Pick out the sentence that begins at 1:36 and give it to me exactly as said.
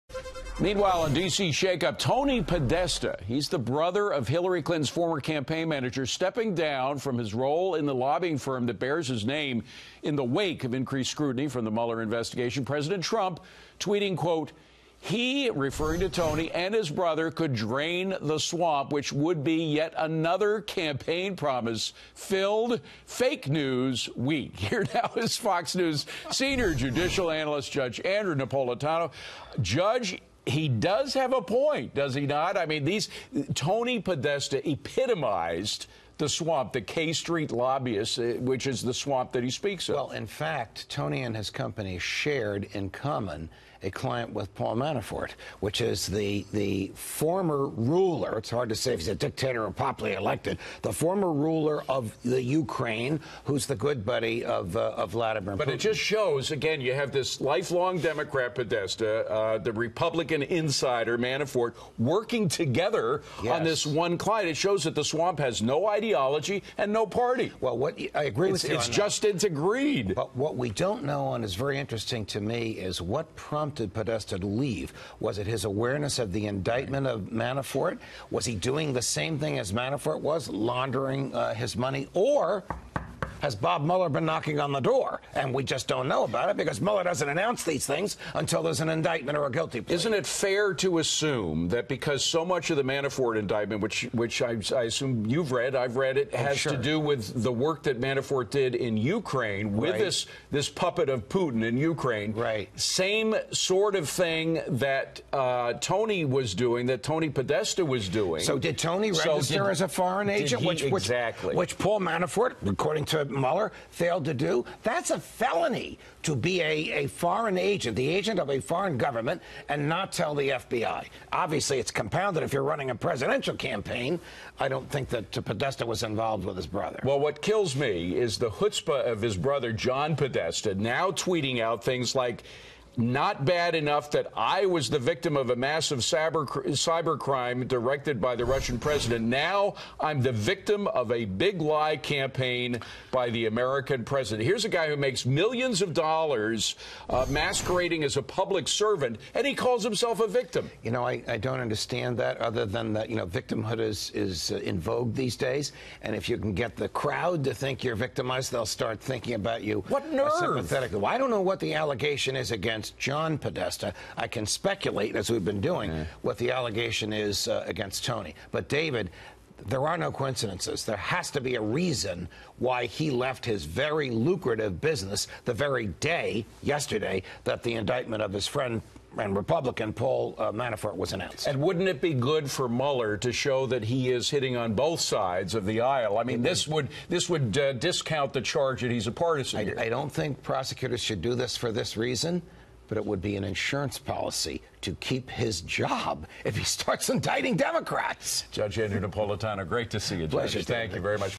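to do with the work that Manafort did in Ukraine with right.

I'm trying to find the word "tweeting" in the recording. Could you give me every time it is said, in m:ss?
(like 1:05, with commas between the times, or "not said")
0:13, 2:11.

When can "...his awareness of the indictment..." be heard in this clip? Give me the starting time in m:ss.
1:15.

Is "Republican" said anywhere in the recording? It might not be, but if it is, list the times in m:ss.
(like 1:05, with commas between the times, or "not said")
0:59, 2:59.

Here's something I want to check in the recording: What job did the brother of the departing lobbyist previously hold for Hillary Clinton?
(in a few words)
Campaign manager.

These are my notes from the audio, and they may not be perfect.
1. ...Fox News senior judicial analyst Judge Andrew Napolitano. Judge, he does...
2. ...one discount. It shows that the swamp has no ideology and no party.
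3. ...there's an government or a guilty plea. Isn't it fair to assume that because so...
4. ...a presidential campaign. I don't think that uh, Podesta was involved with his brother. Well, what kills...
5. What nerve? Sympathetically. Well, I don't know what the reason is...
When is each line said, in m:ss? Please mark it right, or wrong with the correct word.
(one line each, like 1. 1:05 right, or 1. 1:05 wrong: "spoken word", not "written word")
1. 0:25 right
2. 1:03 wrong: "client", not "discount"
3. 1:28 wrong: "indictment", not "government"
4. 2:02 right
5. 2:39 wrong: "allegation", not "reason".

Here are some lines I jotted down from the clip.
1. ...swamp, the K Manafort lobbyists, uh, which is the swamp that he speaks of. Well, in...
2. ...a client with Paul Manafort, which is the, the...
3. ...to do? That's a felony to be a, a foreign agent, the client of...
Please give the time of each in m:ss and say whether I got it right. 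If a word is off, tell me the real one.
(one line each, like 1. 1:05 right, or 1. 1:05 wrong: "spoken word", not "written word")
1. 0:36 wrong: "Street", not "Manafort"
2. 0:43 right
3. 1:54 wrong: "agent", not "client".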